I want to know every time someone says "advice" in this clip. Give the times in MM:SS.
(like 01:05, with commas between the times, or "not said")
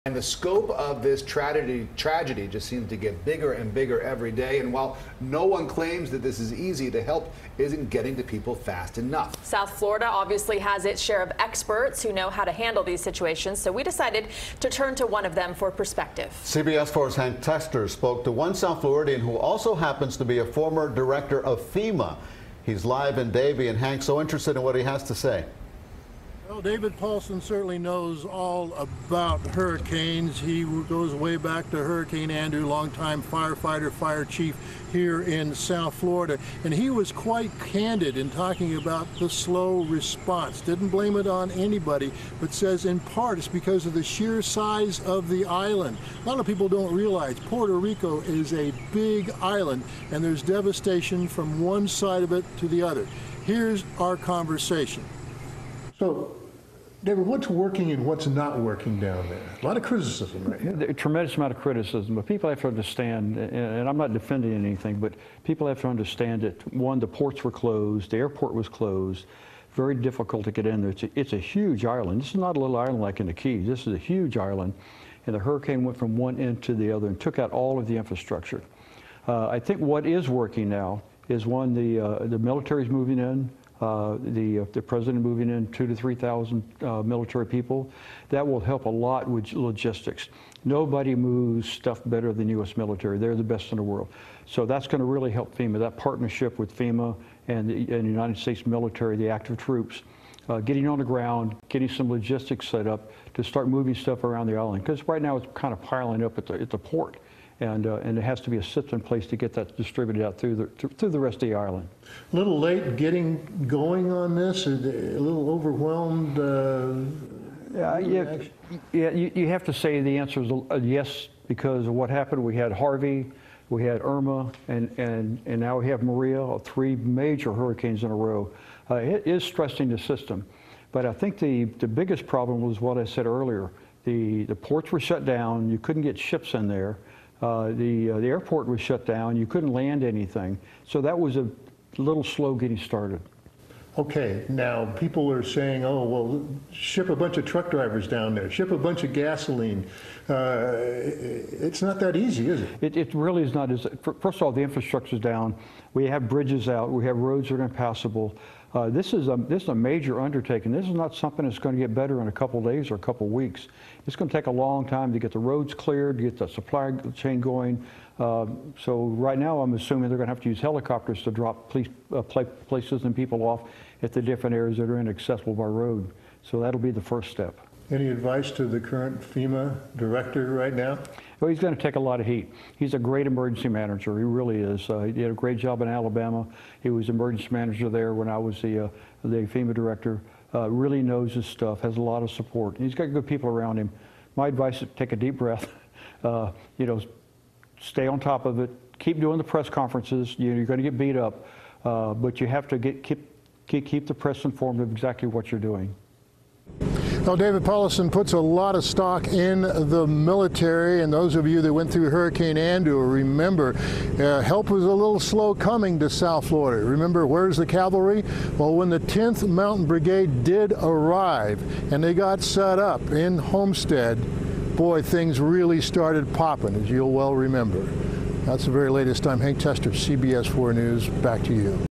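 02:58, 03:14.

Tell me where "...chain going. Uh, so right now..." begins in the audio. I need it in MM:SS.
02:47.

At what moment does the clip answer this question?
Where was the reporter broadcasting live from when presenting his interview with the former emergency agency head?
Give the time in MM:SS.
00:23.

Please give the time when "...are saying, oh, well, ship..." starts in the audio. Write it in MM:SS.
02:25.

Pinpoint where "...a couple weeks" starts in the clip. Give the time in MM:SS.
02:42.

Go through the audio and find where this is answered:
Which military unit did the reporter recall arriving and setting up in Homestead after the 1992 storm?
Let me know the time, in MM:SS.
03:38.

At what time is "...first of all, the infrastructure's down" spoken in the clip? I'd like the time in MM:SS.
02:34.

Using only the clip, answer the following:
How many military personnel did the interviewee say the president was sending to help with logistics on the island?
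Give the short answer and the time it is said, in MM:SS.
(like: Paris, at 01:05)
2,000 to 3,000, at 01:25.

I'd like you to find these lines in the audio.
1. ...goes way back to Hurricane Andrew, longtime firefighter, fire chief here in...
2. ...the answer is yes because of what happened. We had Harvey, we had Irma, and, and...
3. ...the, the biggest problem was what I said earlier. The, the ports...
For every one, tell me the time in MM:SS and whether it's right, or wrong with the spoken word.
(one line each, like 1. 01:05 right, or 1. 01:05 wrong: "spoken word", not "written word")
1. 00:30 right
2. 02:00 right
3. 02:11 right.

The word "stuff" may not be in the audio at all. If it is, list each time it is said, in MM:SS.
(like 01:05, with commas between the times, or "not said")
01:31, 01:43, 03:11.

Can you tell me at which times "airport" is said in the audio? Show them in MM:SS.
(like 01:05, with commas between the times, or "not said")
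01:08, 02:18.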